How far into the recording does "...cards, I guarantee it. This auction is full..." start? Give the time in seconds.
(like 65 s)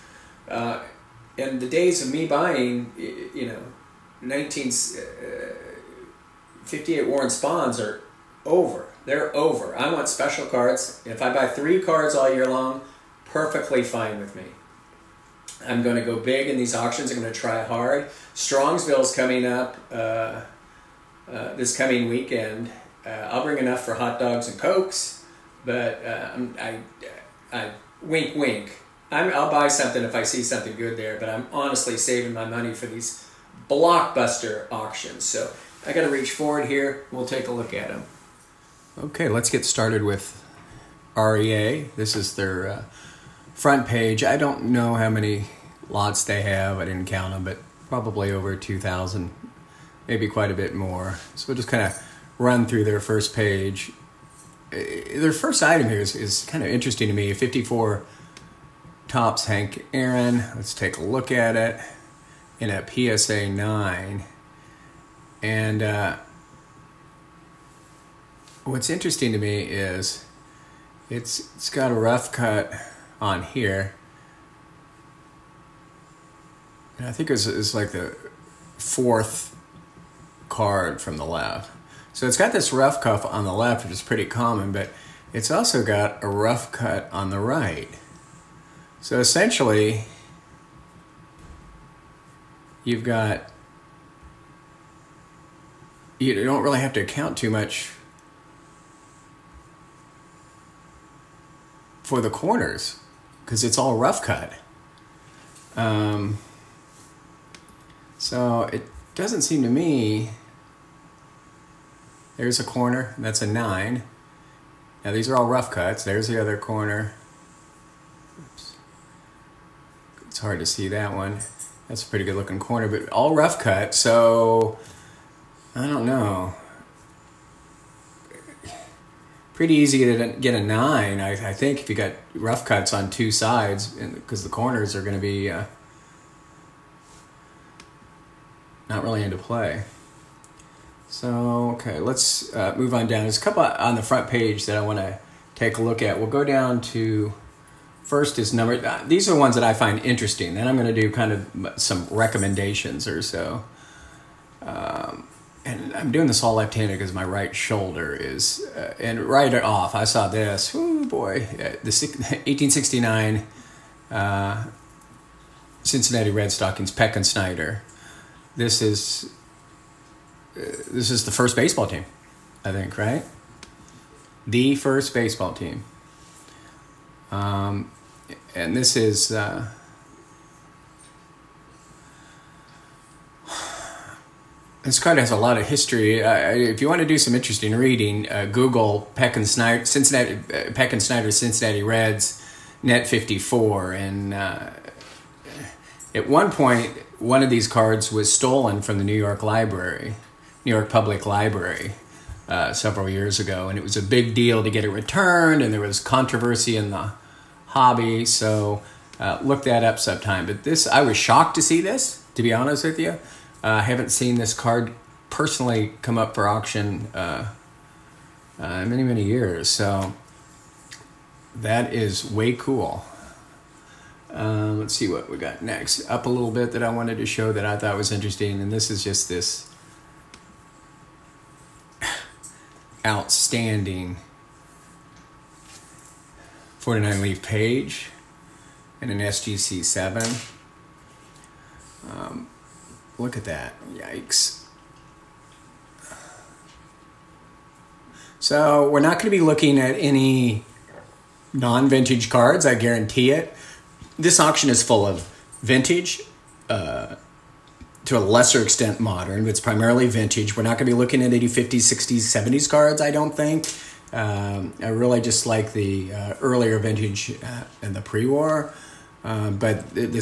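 252 s.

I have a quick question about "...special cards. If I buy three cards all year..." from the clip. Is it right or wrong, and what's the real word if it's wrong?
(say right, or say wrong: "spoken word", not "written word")
right.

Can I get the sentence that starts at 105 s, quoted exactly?
Um, so it doesn't seem to me there's a corner that's a nine.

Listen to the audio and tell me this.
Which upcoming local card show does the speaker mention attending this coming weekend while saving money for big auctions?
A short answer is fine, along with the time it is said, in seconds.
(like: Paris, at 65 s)
Strongsville, at 18 s.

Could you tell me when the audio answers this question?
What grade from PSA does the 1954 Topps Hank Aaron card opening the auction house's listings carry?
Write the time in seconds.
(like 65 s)
62 s.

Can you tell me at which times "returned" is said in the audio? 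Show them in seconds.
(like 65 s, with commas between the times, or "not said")
204 s.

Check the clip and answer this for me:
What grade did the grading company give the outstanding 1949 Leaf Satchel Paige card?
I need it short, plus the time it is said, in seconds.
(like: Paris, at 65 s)
SGC 7, at 239 s.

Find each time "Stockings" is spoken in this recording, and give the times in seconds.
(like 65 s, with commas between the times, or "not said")
166 s.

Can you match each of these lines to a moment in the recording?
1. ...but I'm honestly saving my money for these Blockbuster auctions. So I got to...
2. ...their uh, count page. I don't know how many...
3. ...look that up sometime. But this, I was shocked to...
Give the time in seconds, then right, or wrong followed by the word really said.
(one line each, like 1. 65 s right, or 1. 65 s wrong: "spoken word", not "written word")
1. 31 s right
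2. 42 s wrong: "front", not "count"
3. 209 s right.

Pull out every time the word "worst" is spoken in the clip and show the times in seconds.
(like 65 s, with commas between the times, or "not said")
not said.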